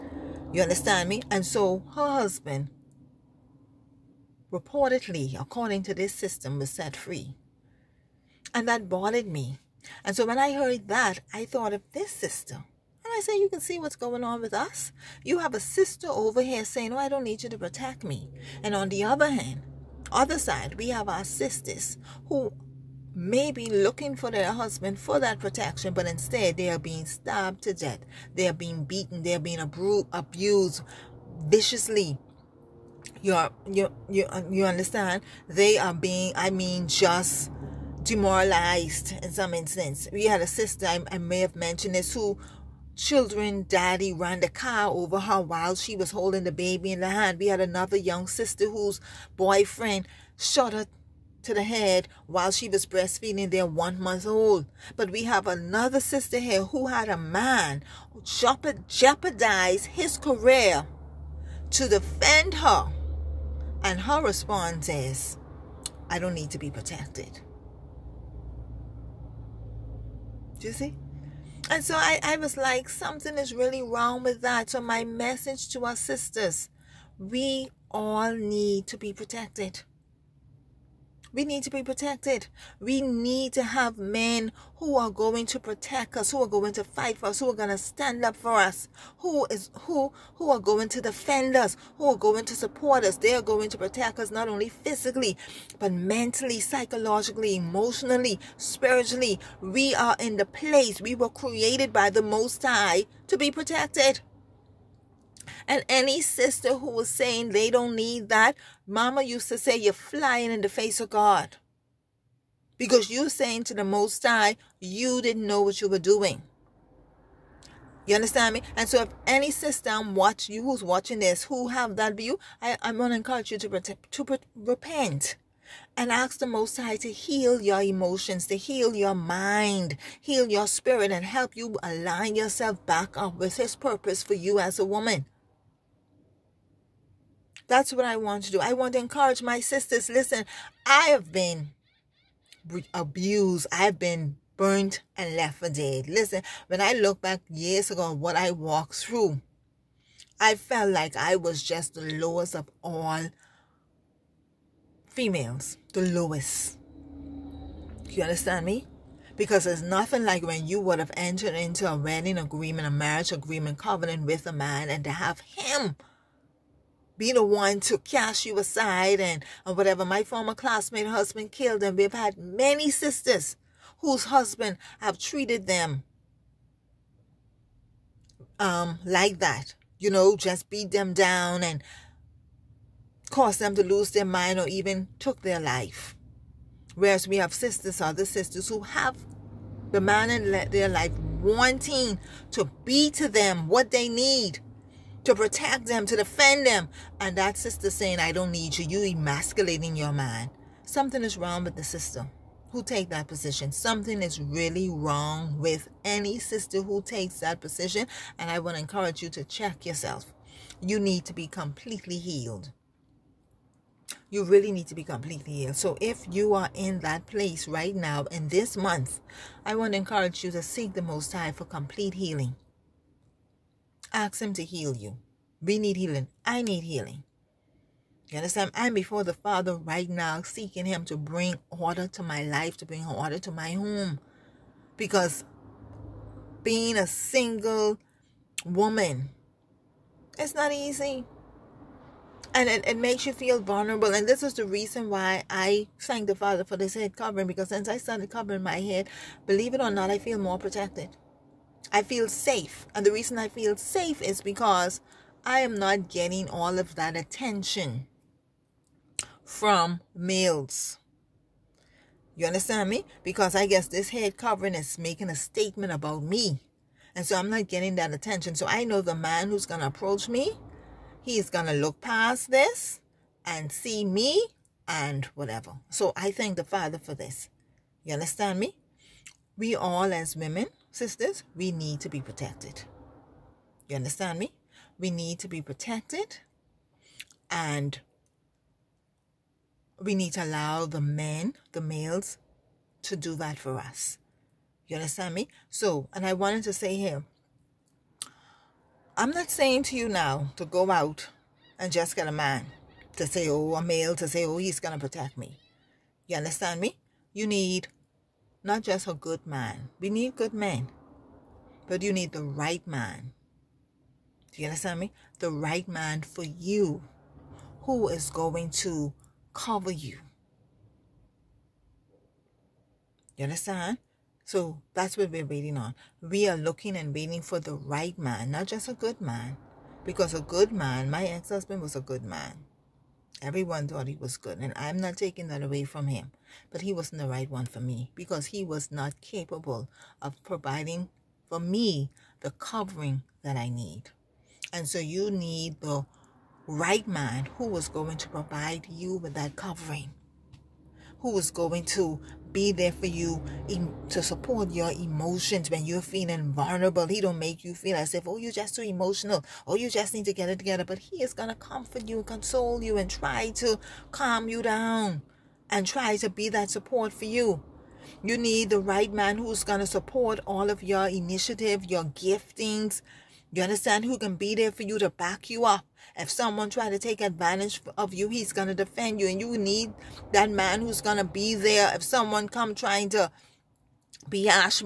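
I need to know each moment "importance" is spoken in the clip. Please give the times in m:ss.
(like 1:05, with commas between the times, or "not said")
not said.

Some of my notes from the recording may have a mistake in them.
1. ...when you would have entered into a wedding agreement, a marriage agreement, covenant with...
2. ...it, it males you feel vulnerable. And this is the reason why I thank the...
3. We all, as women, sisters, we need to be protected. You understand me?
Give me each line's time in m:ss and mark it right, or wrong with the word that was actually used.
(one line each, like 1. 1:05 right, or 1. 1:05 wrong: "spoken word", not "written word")
1. 2:40 right
2. 4:02 wrong: "makes", not "males"
3. 4:39 right.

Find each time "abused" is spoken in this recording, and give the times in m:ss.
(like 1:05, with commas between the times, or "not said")
0:29, 2:22.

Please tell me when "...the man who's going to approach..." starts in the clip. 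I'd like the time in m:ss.
4:29.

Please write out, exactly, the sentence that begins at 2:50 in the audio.
My former classmate husband killed and we've had many sisters whose husband have treated them um, like that.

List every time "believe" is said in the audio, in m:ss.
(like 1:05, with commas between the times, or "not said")
4:09.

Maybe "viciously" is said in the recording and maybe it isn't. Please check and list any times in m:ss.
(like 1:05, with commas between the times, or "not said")
0:31.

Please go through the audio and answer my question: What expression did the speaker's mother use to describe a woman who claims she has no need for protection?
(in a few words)
Flying in the face of God.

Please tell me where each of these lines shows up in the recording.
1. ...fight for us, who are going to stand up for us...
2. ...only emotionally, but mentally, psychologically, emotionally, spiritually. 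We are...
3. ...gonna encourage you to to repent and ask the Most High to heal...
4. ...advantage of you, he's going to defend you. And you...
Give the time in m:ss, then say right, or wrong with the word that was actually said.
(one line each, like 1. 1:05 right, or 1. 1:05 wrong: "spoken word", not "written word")
1. 1:26 right
2. 1:34 wrong: "physically", not "emotionally"
3. 2:02 right
4. 6:17 right.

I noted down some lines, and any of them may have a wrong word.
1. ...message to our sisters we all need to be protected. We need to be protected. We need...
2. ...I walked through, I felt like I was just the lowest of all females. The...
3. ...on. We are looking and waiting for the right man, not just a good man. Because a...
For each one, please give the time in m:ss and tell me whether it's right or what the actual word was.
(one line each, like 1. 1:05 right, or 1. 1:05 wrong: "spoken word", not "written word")
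1. 1:15 right
2. 2:28 right
3. 5:25 right.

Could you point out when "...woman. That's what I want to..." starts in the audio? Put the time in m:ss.
2:14.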